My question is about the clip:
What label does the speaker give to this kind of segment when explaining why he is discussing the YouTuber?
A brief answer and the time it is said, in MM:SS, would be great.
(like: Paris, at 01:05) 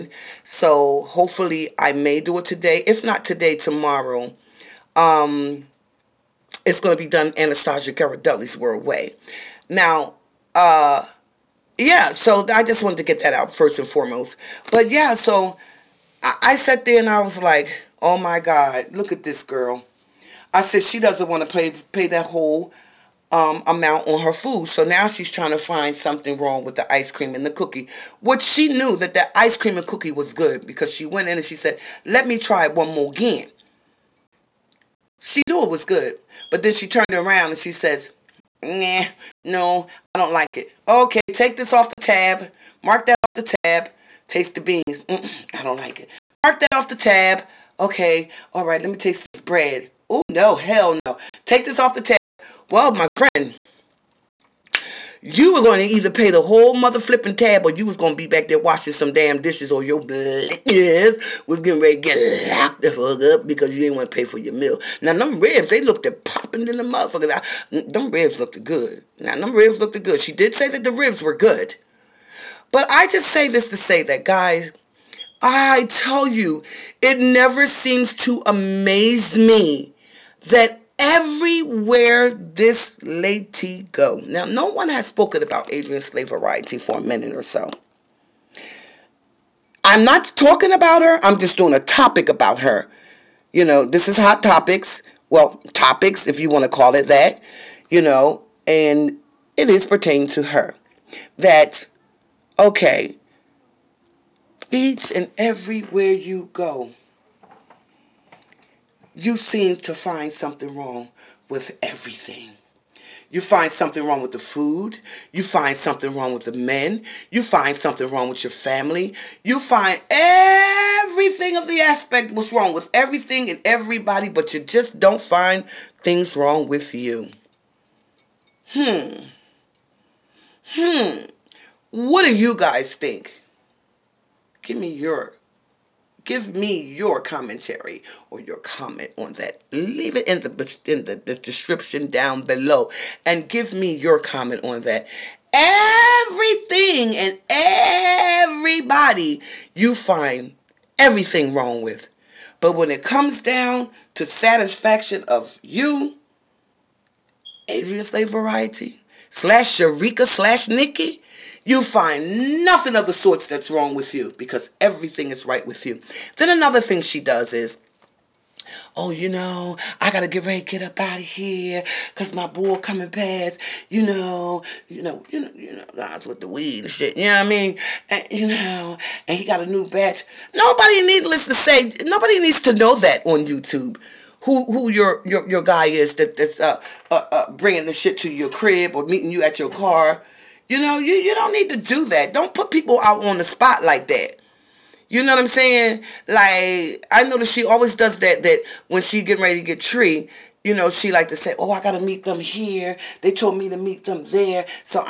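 hot topics, at 01:34.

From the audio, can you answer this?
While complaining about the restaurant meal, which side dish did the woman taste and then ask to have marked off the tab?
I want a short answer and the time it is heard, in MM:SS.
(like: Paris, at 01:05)
beans, at 00:44.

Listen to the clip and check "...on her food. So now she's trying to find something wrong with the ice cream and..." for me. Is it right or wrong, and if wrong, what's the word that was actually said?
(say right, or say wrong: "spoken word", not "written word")
right.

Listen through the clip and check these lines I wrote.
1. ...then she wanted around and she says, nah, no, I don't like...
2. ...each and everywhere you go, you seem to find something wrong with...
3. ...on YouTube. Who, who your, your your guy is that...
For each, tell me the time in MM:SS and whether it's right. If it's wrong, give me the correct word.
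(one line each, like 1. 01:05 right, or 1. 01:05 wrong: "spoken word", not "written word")
1. 00:36 wrong: "turned", not "wanted"
2. 01:44 right
3. 03:03 right.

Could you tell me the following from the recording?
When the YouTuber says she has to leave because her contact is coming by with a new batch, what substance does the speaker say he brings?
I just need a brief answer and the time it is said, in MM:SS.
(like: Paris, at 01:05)
weed, at 02:56.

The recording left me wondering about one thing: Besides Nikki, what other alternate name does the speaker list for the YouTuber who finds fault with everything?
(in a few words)
Sharika.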